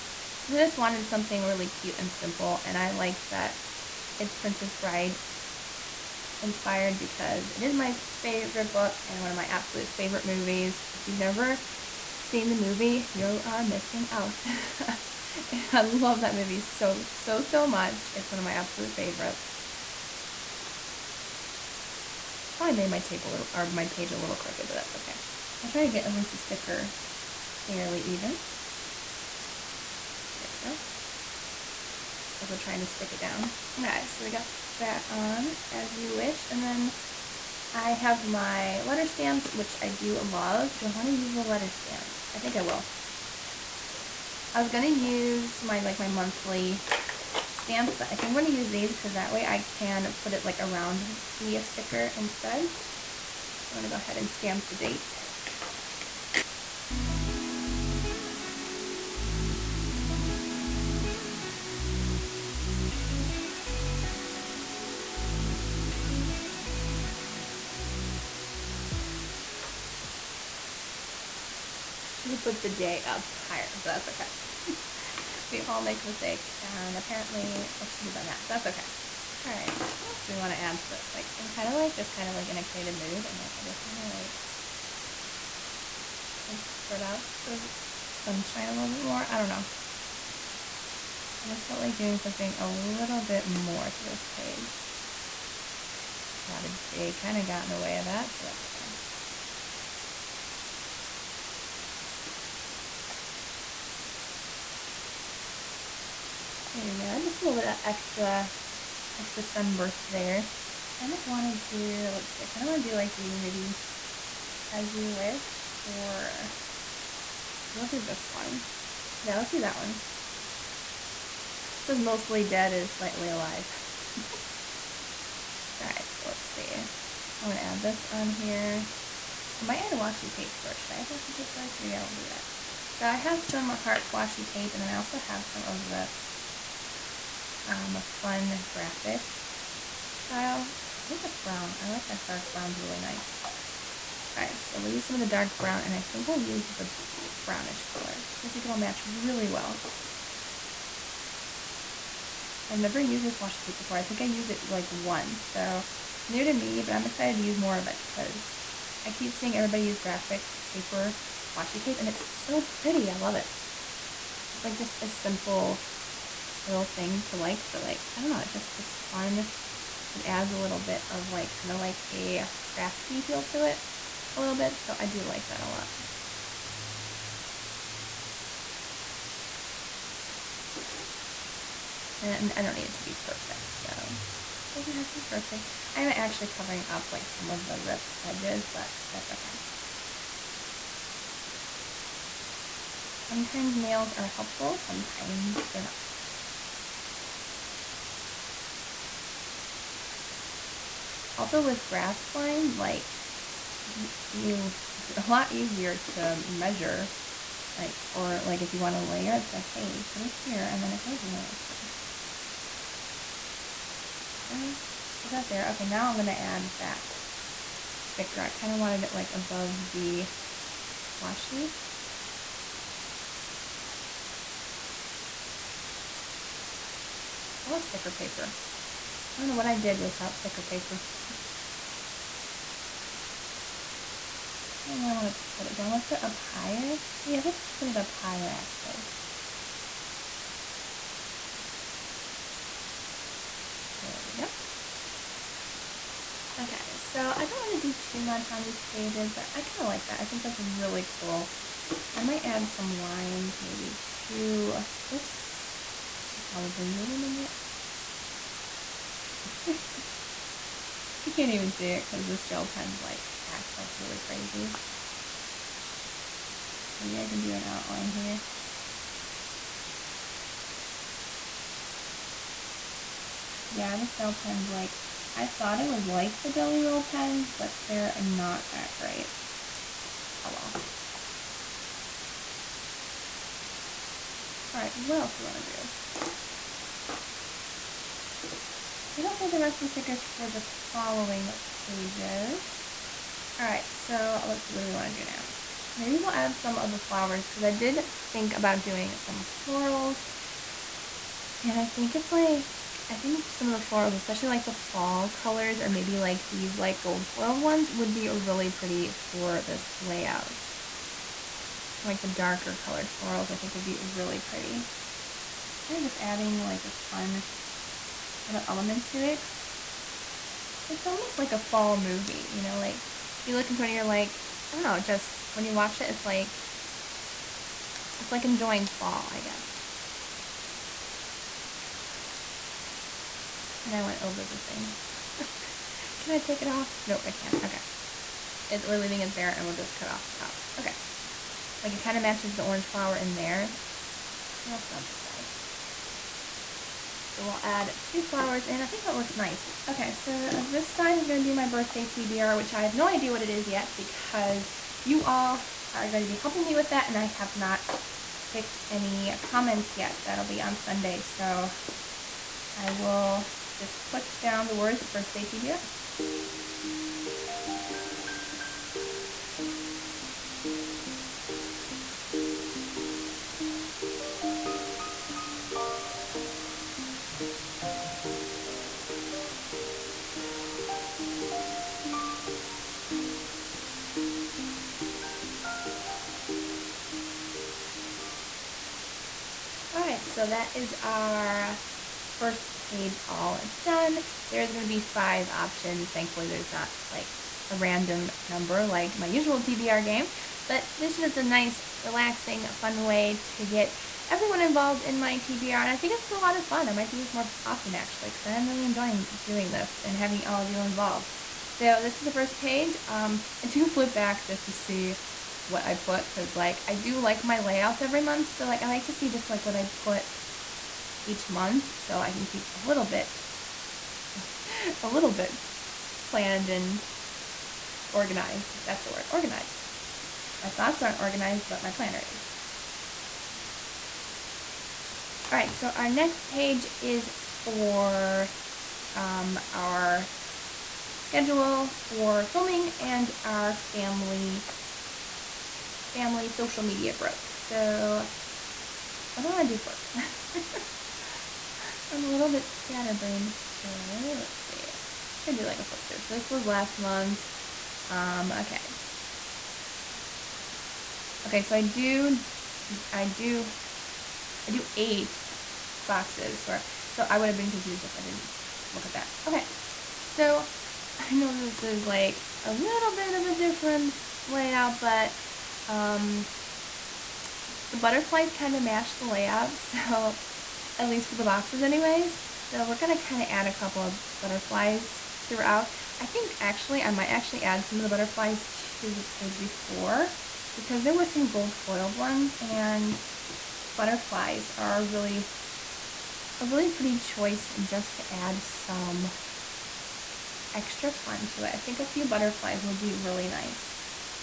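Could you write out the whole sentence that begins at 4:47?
I think I'll save the rest of the stickers for the following pages.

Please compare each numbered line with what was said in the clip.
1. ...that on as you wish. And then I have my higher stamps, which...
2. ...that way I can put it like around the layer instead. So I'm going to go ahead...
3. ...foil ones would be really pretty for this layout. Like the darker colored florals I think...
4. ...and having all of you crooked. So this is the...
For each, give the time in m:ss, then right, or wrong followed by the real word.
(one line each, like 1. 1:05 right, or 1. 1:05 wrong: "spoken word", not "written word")
1. 0:34 wrong: "letter", not "higher"
2. 0:49 wrong: "sticker", not "layer"
3. 5:07 right
4. 6:50 wrong: "involved", not "crooked".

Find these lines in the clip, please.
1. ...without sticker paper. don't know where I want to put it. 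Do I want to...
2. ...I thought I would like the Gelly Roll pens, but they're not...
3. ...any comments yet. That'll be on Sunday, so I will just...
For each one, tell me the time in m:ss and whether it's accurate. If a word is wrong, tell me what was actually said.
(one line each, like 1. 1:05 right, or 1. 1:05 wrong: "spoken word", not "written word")
1. 3:49 right
2. 4:35 right
3. 5:58 right.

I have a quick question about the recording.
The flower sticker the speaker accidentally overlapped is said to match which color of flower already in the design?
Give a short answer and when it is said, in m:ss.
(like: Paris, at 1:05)
Orange, at 5:42.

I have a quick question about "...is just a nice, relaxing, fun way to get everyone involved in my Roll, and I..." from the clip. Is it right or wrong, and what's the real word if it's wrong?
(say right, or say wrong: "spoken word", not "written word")
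wrong: "TBR", not "Roll".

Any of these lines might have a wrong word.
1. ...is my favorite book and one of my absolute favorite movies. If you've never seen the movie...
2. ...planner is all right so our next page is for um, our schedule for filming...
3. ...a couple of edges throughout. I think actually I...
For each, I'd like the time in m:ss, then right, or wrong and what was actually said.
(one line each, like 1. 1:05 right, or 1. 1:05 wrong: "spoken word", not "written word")
1. 0:07 right
2. 7:11 right
3. 8:03 wrong: "butterflies", not "edges".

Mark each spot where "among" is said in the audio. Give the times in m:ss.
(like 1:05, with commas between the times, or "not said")
not said.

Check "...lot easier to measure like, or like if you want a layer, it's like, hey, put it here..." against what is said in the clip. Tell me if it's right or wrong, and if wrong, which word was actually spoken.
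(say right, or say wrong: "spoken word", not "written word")
right.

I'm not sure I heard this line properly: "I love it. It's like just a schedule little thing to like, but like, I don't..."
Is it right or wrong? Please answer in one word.
wrong.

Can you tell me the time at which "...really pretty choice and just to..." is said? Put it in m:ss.
8:16.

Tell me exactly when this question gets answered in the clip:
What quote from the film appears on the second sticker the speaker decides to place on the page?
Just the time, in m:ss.
2:01.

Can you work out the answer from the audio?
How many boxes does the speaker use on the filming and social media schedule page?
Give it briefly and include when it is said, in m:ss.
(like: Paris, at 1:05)
8, at 7:44.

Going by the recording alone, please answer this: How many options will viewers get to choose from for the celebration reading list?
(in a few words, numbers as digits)
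5.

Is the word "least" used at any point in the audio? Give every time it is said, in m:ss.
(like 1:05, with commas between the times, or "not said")
0:26, 8:01.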